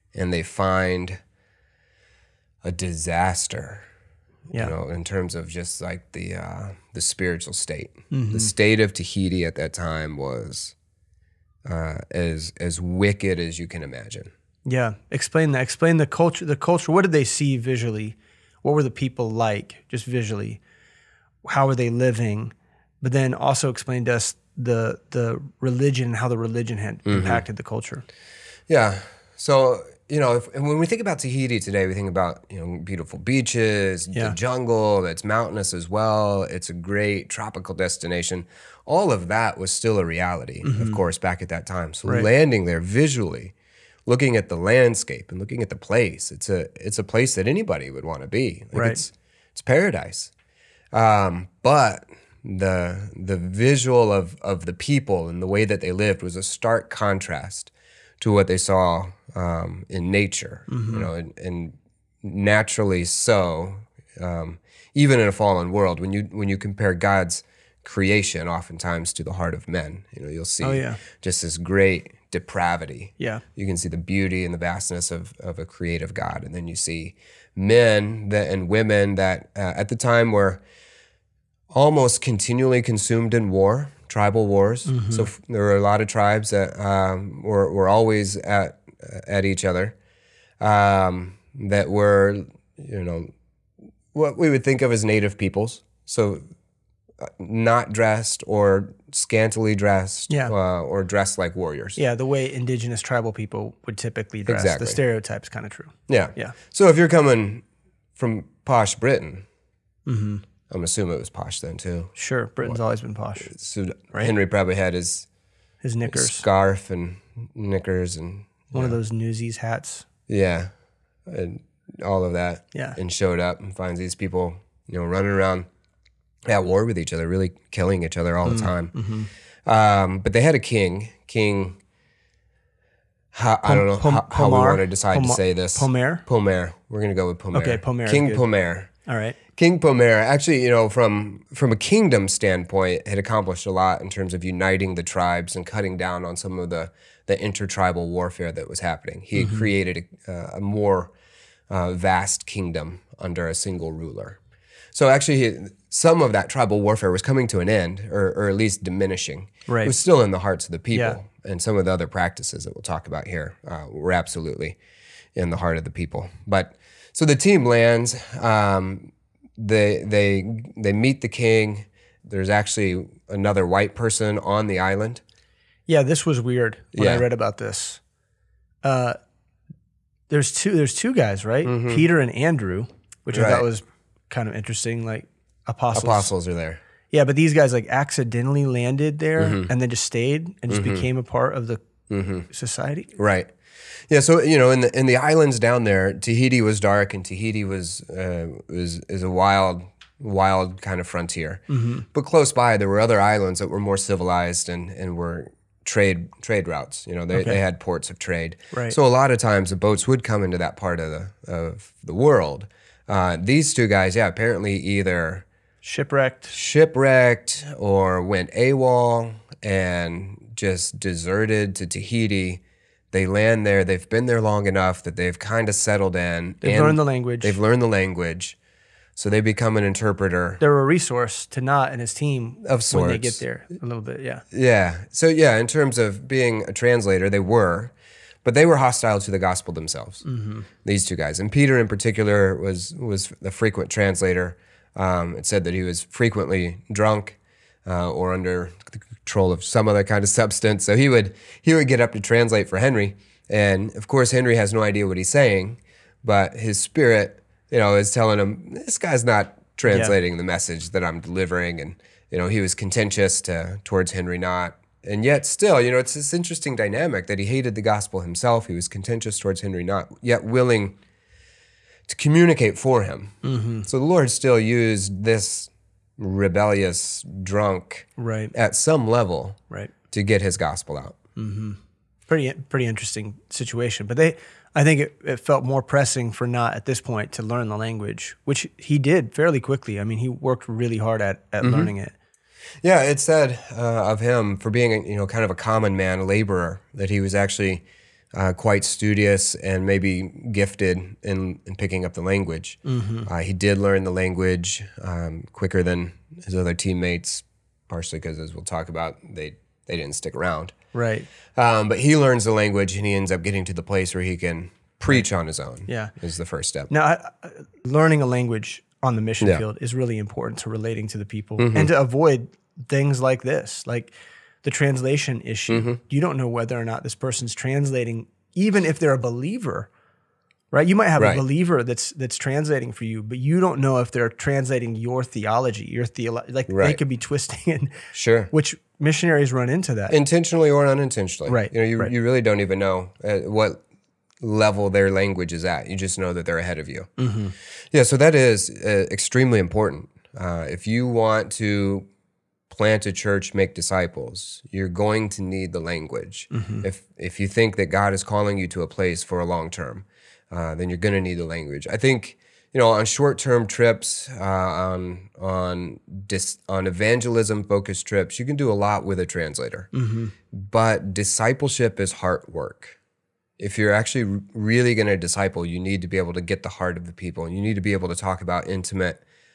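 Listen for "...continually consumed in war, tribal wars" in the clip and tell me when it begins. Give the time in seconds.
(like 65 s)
82 s.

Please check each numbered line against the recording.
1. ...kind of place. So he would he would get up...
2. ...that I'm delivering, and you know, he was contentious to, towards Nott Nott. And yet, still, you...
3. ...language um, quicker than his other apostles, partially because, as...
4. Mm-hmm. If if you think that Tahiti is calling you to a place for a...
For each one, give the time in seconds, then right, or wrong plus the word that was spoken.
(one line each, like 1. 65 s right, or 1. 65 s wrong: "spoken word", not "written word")
1. 250 s wrong: "substance", not "place"
2. 260 s wrong: "Henry", not "Nott"
3. 304 s wrong: "teammates", not "apostles"
4. 356 s wrong: "God", not "Tahiti".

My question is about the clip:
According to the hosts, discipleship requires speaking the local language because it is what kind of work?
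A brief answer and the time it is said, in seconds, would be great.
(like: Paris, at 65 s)
heart work, at 372 s.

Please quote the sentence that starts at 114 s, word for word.
Henry probably had his his knickers, scarf, and knickers and one yeah.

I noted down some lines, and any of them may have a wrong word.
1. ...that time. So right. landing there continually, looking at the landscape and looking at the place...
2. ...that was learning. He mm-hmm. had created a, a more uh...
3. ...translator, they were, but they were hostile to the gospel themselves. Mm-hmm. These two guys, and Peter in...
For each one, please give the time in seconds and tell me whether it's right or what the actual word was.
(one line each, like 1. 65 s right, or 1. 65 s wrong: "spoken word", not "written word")
1. 41 s wrong: "visually", not "continually"
2. 148 s wrong: "happening", not "learning"
3. 236 s right.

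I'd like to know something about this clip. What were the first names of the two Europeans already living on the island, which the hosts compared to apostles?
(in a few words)
Peter and Andrew.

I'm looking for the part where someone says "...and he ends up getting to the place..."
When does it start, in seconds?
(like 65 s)
312 s.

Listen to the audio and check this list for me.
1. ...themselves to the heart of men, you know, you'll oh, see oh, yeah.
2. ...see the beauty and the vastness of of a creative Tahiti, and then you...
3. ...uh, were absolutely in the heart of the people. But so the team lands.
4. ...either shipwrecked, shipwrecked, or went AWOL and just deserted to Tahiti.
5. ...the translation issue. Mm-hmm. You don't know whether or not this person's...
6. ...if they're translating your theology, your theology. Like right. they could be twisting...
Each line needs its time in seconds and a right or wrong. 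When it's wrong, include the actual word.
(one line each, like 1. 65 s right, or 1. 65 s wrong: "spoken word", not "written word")
1. 68 s wrong: "oftentimes", not "themselves"
2. 73 s wrong: "God", not "Tahiti"
3. 163 s right
4. 214 s right
5. 324 s right
6. 333 s right.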